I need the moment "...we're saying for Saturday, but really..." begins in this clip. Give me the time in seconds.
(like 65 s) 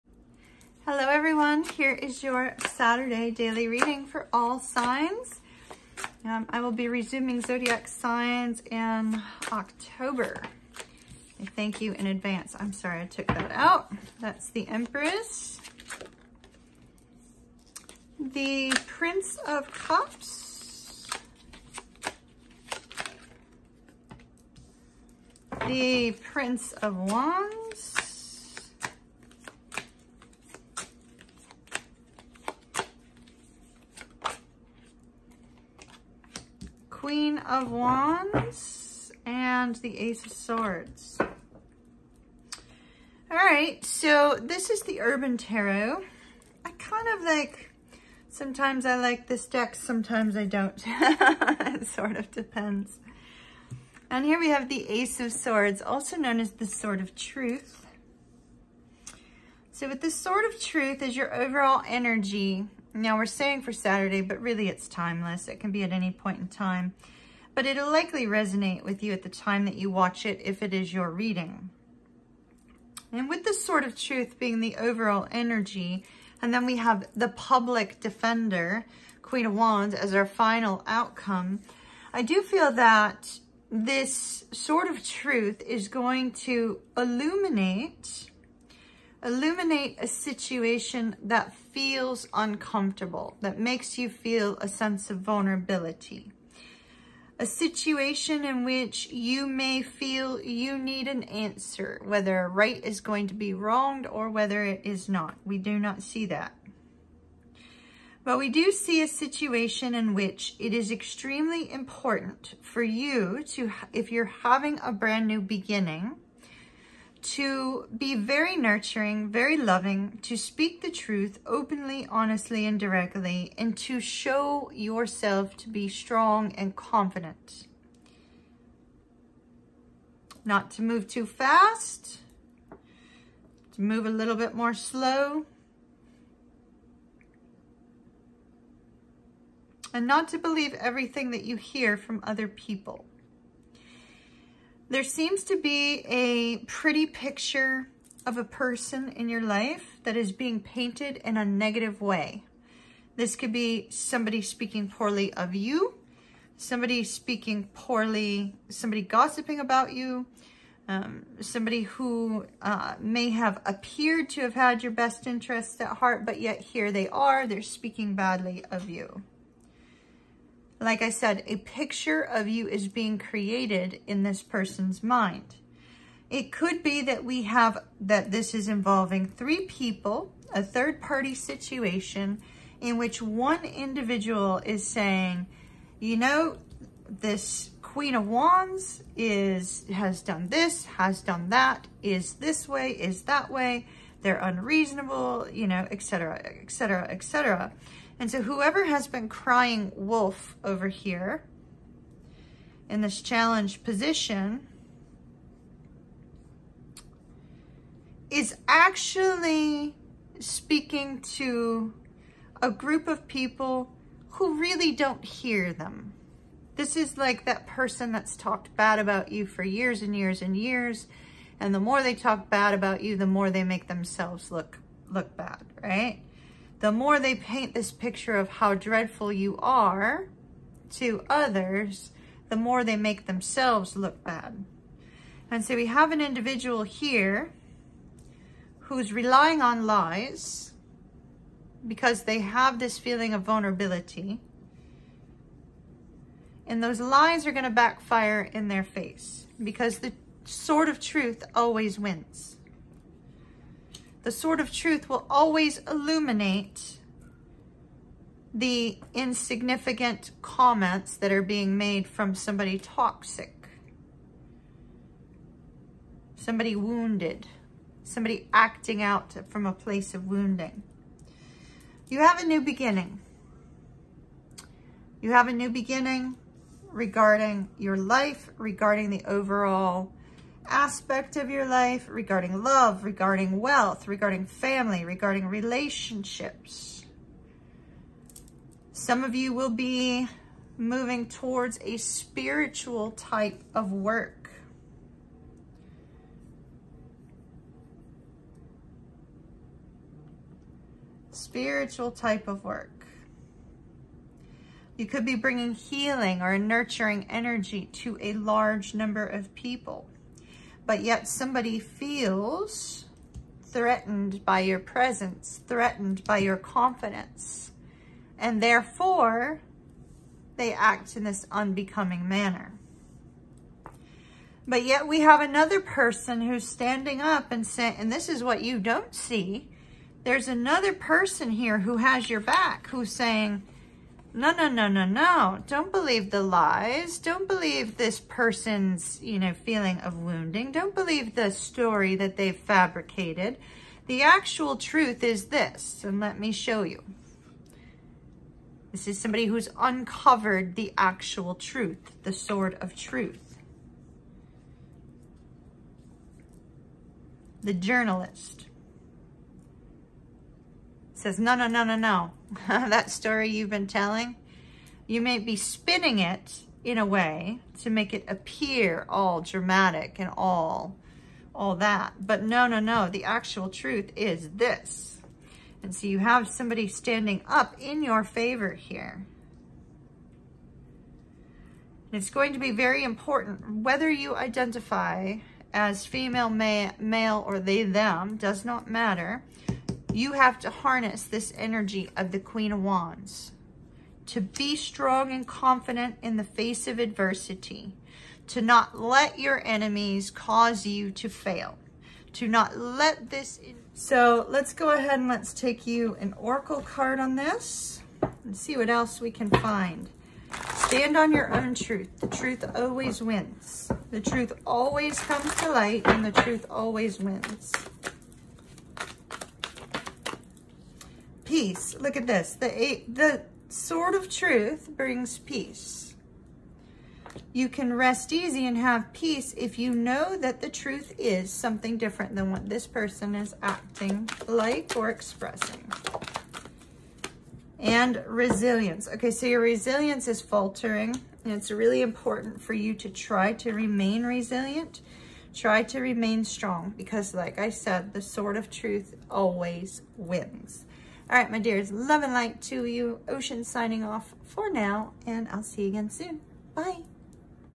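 63 s.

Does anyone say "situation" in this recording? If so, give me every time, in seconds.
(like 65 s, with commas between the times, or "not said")
90 s, 97 s, 109 s, 181 s.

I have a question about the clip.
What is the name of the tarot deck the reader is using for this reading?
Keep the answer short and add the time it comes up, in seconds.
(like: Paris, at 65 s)
Urban Tarot, at 45 s.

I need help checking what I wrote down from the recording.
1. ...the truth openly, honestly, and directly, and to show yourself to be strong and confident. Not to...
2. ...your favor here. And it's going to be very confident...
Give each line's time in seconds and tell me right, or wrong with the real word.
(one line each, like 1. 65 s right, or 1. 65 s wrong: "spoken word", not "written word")
1. 120 s right
2. 378 s wrong: "important", not "confident".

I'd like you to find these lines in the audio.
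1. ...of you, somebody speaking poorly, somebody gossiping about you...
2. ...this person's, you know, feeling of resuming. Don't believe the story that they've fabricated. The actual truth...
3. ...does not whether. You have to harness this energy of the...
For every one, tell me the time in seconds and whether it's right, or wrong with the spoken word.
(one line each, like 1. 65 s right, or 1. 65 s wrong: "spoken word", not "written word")
1. 155 s right
2. 337 s wrong: "wounding", not "resuming"
3. 388 s wrong: "matter", not "whether".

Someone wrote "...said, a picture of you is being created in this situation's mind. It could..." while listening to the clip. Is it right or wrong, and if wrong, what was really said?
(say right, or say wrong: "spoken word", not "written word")
wrong: "person", not "situation".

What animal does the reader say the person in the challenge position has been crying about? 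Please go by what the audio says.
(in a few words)
wolf.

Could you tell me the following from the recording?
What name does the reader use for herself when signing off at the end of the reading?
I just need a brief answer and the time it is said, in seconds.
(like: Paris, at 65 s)
Ocean, at 453 s.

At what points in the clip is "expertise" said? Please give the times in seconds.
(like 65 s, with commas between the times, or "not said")
not said.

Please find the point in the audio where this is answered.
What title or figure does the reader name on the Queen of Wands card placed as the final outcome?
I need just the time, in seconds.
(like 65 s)
77 s.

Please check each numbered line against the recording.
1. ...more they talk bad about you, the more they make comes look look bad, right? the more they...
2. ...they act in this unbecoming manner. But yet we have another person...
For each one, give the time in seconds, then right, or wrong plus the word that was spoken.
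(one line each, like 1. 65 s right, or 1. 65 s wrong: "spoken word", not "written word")
1. 221 s wrong: "themselves", not "comes"
2. 320 s right.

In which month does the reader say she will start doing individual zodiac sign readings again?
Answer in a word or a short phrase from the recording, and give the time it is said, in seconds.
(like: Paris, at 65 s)
October, at 9 s.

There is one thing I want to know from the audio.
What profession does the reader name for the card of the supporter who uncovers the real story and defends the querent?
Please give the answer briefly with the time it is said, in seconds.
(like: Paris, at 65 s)
journalist, at 357 s.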